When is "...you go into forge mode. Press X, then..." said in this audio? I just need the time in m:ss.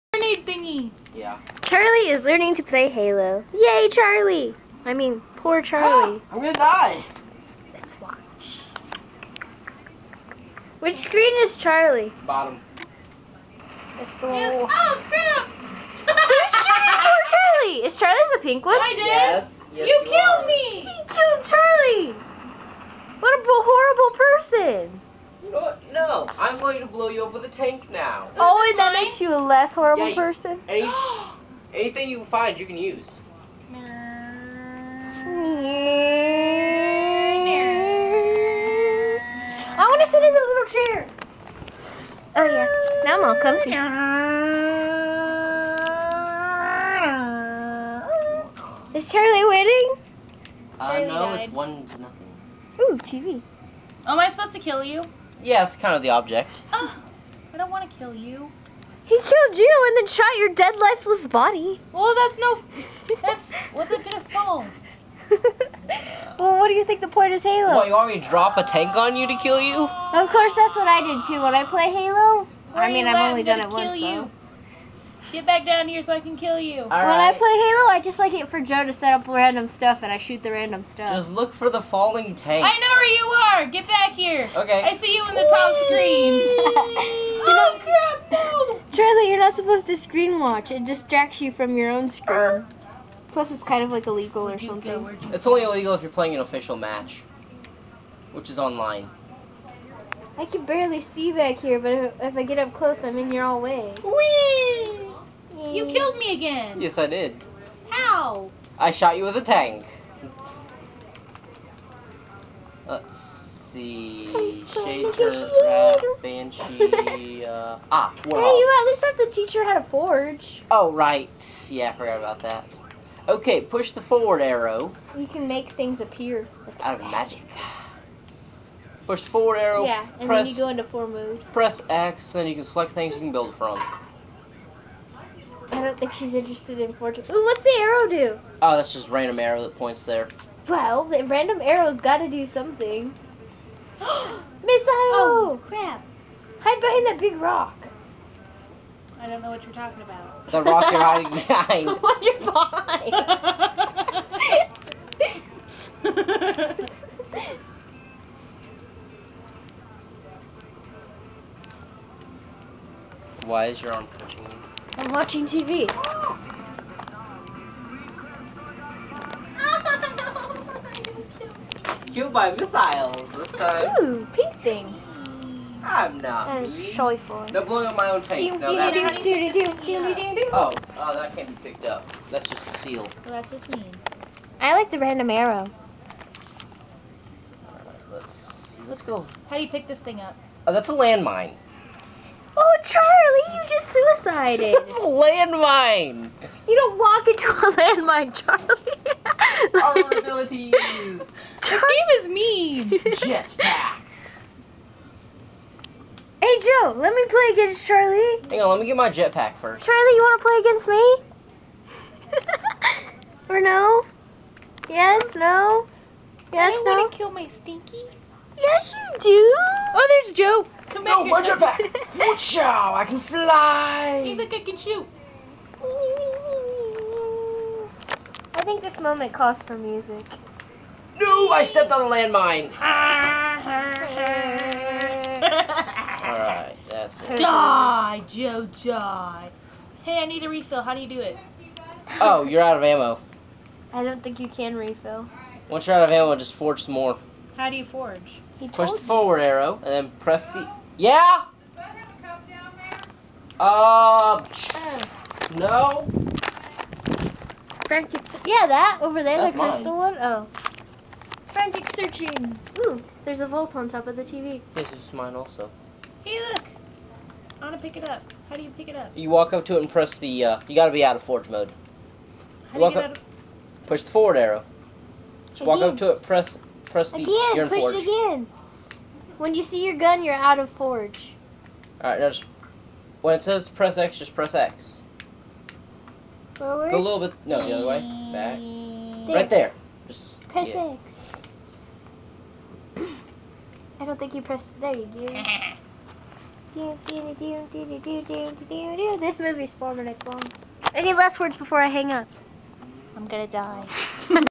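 2:10.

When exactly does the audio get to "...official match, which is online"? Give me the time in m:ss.
1:36.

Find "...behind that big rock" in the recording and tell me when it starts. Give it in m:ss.
2:26.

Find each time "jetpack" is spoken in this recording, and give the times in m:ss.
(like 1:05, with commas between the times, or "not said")
3:22, 3:29.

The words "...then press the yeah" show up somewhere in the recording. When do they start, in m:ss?
4:09.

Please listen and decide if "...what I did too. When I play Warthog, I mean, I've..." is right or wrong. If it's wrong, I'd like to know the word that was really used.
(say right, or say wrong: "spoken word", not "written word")
wrong: "Halo", not "Warthog".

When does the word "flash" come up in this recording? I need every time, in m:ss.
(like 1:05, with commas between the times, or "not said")
not said.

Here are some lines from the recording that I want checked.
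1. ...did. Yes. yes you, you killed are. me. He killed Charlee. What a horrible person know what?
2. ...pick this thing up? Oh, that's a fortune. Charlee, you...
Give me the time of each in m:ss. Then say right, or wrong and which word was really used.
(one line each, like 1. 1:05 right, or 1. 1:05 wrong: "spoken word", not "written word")
1. 0:18 right
2. 3:09 wrong: "landmine", not "fortune".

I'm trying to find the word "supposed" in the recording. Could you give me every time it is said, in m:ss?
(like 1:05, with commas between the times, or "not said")
0:54, 1:29.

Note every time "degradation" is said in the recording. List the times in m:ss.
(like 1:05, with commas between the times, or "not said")
not said.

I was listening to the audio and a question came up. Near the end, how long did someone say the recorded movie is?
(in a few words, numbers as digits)
4 minutes.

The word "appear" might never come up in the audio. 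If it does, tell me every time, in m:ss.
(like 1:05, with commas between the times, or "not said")
2:06.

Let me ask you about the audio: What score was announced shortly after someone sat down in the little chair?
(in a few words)
1 to 0.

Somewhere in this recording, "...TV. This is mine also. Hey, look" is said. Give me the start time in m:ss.
4:24.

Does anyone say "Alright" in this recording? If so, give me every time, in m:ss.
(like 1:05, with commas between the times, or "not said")
3:56, 4:41.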